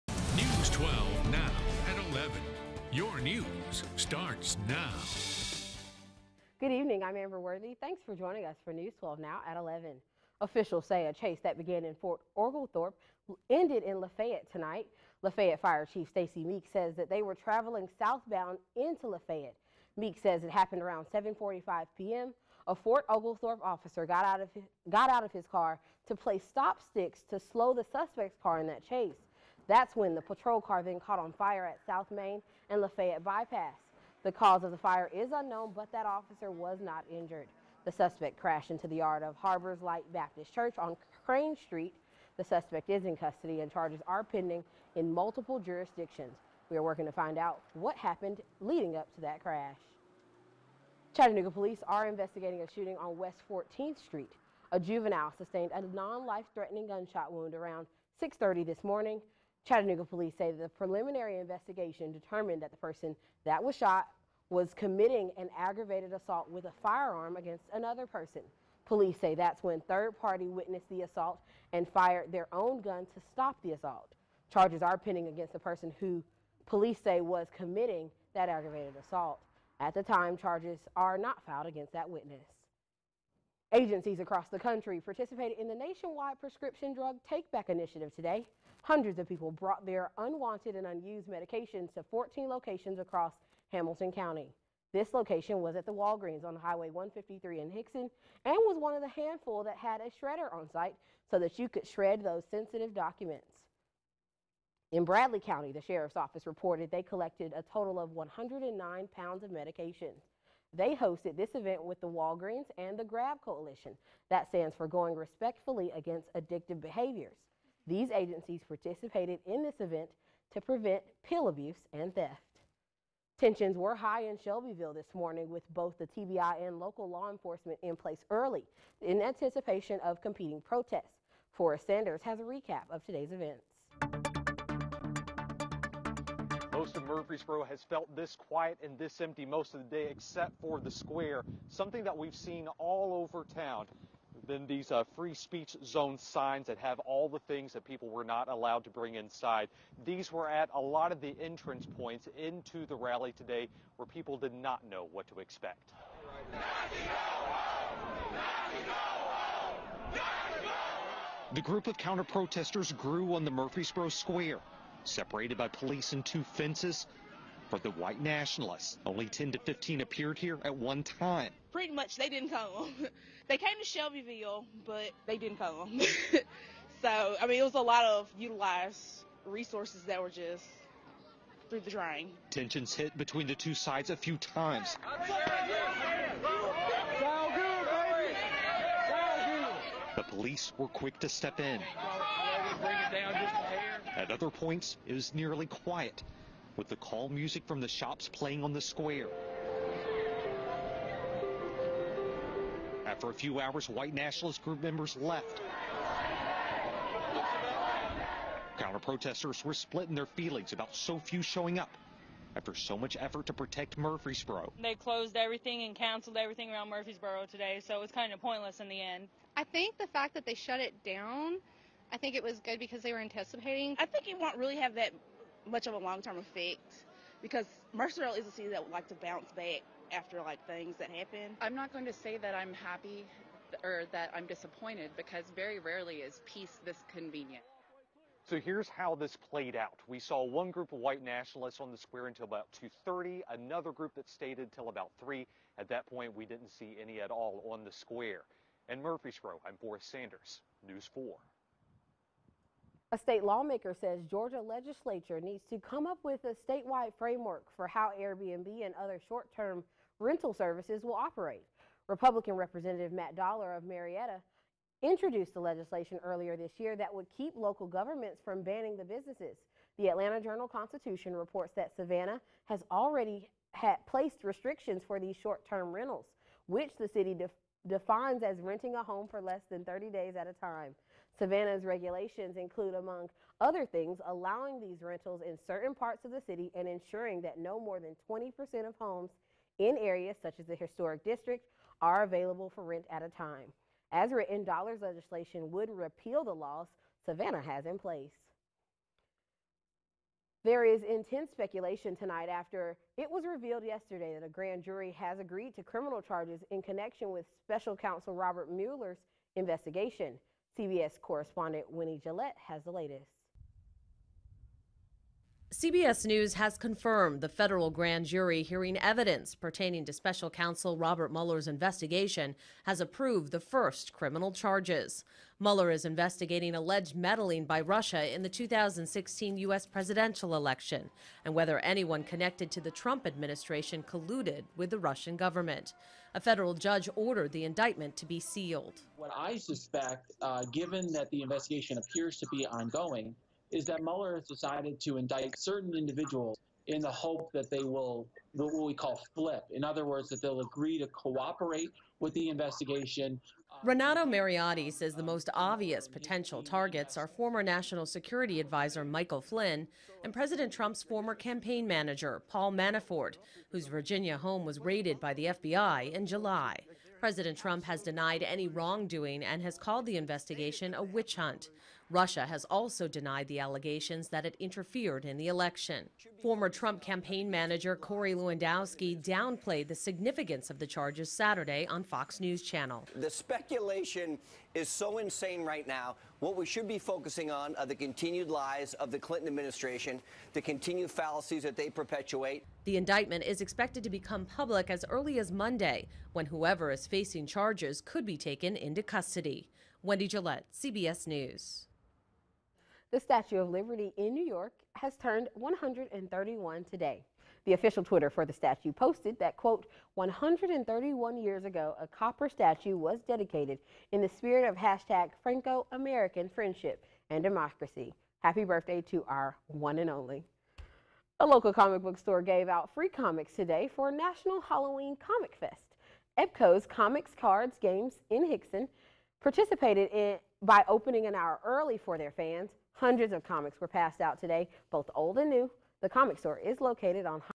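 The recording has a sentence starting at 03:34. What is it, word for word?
They closed everything and canceled everything around Murfreesboro today, so it was kind of pointless in the end.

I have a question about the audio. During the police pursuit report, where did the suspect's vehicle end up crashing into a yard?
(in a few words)
Harbors Light Baptist Church.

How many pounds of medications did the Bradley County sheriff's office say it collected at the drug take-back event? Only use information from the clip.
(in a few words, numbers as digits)
109.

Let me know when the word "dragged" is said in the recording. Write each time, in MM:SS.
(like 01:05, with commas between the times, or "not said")
not said.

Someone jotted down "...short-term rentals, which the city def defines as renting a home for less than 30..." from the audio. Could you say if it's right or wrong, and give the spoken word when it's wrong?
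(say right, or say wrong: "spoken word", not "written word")
right.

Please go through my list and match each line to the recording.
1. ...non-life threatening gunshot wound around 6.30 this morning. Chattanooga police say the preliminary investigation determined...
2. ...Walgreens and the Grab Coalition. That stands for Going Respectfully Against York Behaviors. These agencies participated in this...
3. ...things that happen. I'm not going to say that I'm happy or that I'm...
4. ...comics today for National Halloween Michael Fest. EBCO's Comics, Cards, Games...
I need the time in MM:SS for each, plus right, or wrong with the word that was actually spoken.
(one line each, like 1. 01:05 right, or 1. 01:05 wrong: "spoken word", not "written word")
1. 00:55 right
2. 01:52 wrong: "Addictive", not "York"
3. 03:50 right
4. 07:03 wrong: "Comic", not "Michael".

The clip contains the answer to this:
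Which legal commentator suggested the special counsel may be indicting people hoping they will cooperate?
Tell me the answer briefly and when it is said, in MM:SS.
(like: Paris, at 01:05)
Renato Mariotti, at 05:53.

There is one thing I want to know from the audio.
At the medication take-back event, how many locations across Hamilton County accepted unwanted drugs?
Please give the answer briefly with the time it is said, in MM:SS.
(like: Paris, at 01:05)
14, at 01:32.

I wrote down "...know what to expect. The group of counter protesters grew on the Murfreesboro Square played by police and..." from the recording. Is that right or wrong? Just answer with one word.
wrong.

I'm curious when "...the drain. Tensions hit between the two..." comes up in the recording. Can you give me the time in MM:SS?
03:01.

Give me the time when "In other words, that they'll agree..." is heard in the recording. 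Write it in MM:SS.
05:49.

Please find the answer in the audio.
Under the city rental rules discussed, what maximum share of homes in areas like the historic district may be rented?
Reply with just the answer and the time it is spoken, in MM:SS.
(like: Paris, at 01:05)
20%, at 04:48.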